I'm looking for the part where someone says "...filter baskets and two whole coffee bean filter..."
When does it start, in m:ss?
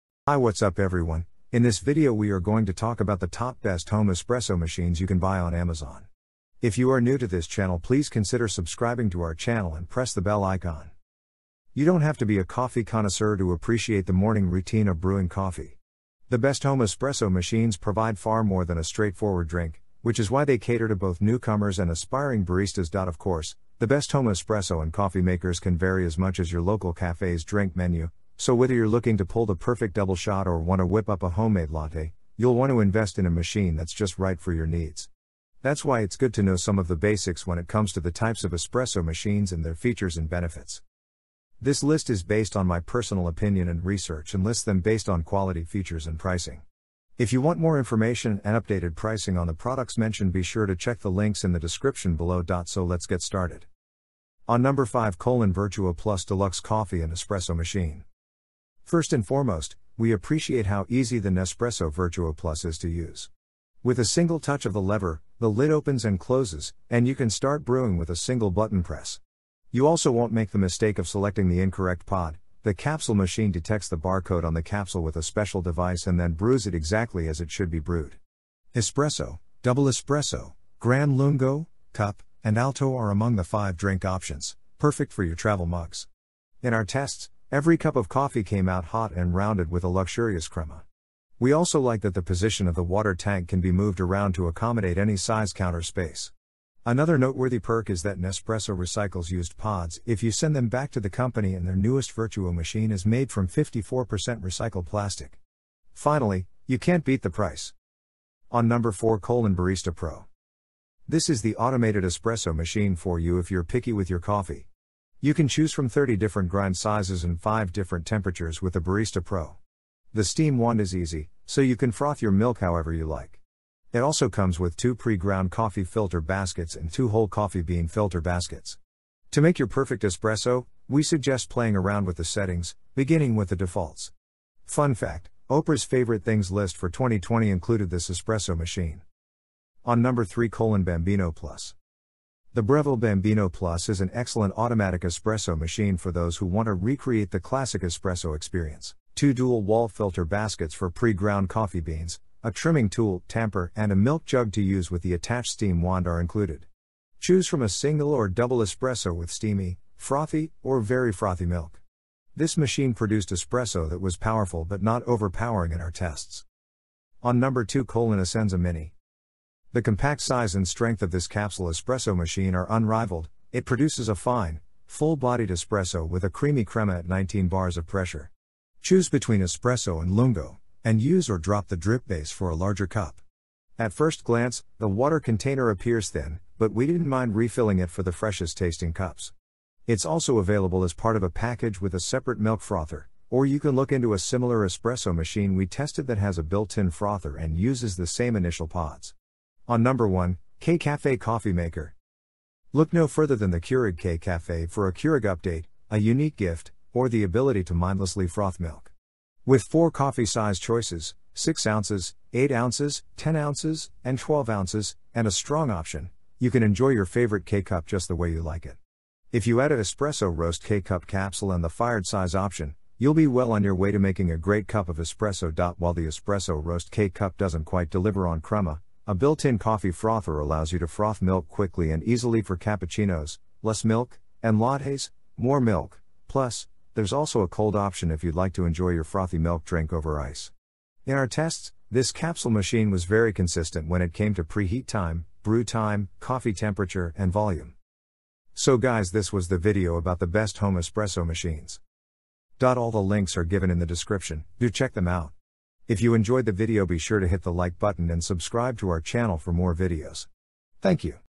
2:05.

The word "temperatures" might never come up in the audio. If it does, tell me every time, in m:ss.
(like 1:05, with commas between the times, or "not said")
1:58, 4:06.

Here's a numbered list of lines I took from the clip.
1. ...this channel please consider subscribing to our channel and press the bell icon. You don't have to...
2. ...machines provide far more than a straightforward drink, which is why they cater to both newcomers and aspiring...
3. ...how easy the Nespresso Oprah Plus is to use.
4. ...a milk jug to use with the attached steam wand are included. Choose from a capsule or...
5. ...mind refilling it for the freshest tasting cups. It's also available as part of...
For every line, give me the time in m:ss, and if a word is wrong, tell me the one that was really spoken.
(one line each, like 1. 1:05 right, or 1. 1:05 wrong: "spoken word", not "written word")
1. 0:07 right
2. 0:17 right
3. 1:00 wrong: "Vertuo", not "Oprah"
4. 2:33 wrong: "single", not "capsule"
5. 3:07 right.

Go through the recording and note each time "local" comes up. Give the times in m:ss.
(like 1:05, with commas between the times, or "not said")
0:26.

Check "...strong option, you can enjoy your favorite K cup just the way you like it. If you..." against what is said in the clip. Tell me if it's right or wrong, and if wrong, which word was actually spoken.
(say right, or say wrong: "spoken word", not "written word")
right.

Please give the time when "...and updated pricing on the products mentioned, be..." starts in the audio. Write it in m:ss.
0:48.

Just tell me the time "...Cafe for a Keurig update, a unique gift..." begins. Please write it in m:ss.
3:24.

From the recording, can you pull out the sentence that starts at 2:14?
Fun fact Oprah's favorite things list for 2020 included this espresso machine.